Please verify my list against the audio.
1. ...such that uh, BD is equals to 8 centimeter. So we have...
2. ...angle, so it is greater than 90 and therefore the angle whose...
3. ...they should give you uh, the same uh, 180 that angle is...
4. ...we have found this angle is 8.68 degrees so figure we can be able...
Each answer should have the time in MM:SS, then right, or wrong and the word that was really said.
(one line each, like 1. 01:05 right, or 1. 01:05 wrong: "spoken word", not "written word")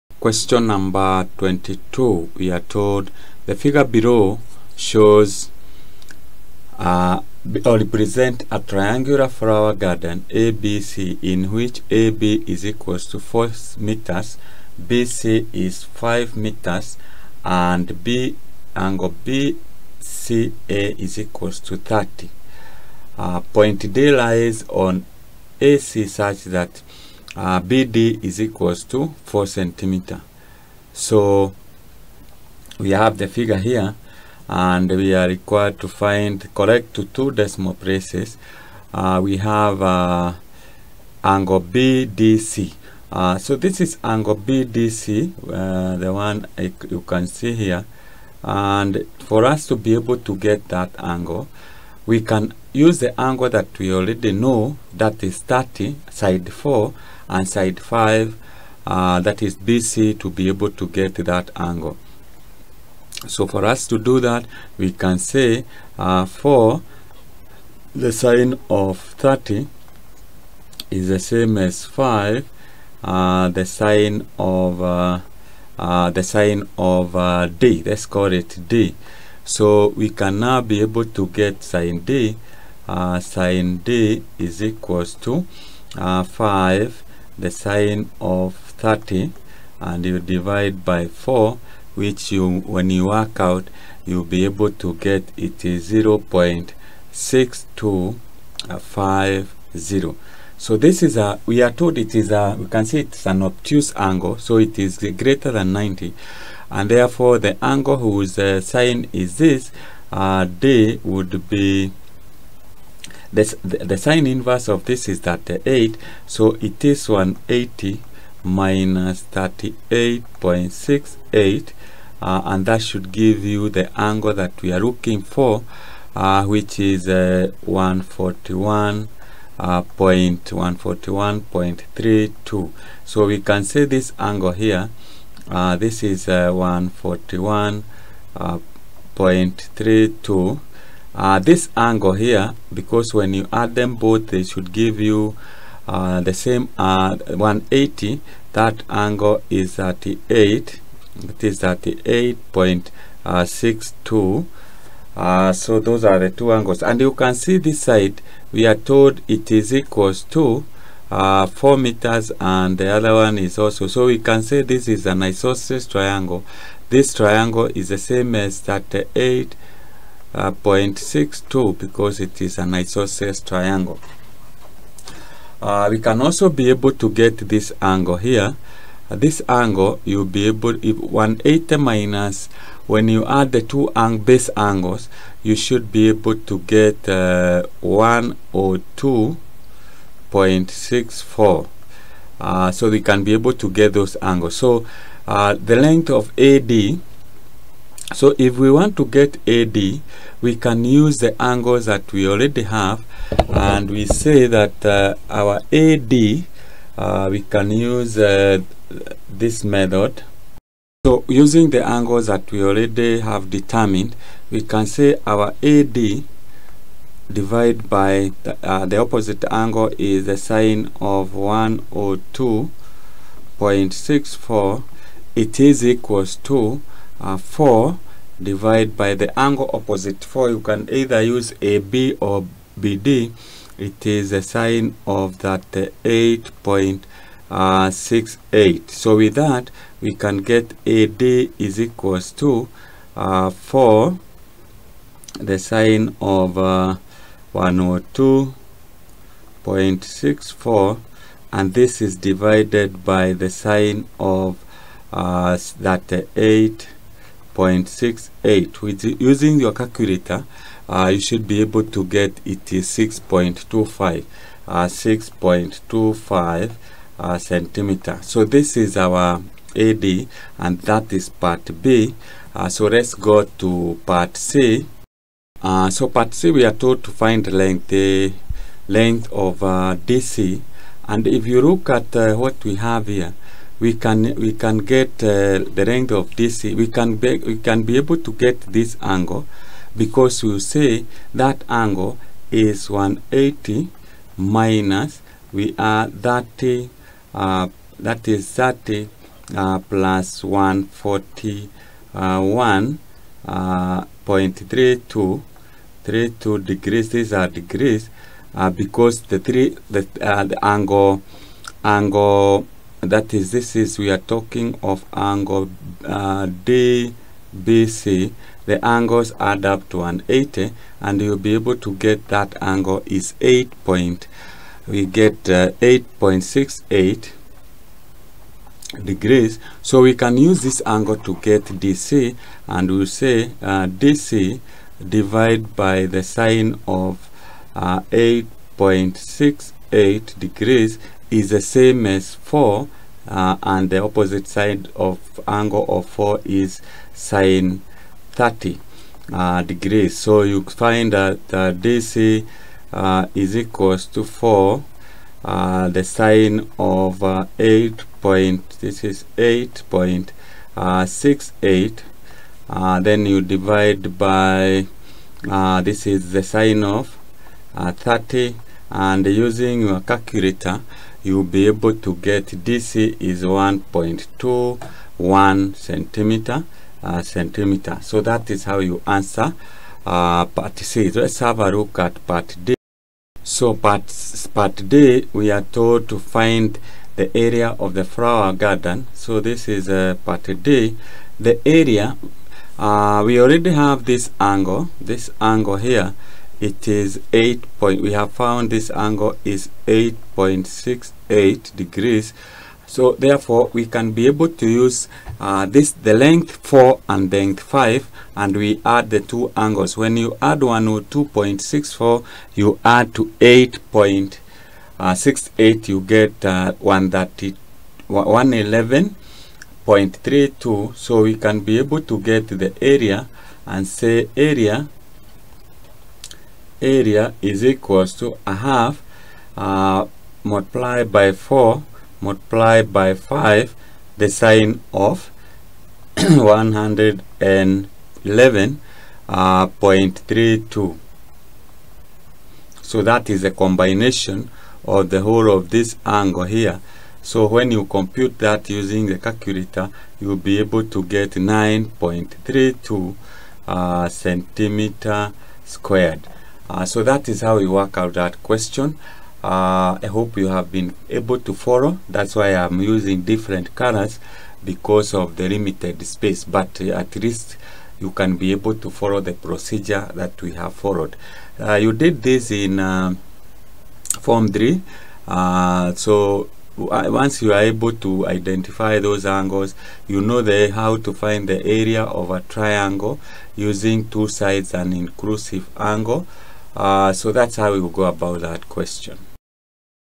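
1. 00:26 wrong: "4", not "8"
2. 01:43 right
3. 02:24 right
4. 06:38 wrong: "therefore", not "figure".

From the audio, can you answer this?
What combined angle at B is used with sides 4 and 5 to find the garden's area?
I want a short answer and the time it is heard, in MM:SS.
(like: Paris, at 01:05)
111.32 degrees, at 06:56.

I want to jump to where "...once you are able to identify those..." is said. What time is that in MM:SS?
07:56.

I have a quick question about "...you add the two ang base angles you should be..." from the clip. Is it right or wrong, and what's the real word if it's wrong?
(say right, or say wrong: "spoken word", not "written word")
right.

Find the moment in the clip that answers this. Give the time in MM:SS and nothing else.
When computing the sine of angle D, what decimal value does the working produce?
01:35.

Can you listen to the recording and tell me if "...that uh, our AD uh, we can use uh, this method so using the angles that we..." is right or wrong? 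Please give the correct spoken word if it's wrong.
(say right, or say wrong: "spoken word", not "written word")
right.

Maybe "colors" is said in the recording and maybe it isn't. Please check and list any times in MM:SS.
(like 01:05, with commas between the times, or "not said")
07:43.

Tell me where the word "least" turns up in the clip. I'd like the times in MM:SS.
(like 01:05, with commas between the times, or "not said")
07:47.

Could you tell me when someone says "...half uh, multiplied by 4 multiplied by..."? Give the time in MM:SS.
07:08.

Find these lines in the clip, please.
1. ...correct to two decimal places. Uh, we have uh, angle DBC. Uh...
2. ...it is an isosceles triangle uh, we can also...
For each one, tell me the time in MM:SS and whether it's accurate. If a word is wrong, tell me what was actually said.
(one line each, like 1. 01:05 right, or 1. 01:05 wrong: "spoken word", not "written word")
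1. 00:36 wrong: "BDC", not "DBC"
2. 02:52 right.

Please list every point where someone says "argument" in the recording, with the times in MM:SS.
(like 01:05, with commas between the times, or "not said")
not said.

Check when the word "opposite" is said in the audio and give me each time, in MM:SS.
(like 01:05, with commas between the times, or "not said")
03:38, 03:49, 05:44.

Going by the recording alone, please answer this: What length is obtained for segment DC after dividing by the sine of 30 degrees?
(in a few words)
1.21.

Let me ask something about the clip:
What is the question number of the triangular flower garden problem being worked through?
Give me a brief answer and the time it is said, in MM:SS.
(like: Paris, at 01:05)
22, at 00:01.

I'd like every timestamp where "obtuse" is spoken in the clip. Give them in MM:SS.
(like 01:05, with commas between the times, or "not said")
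01:43.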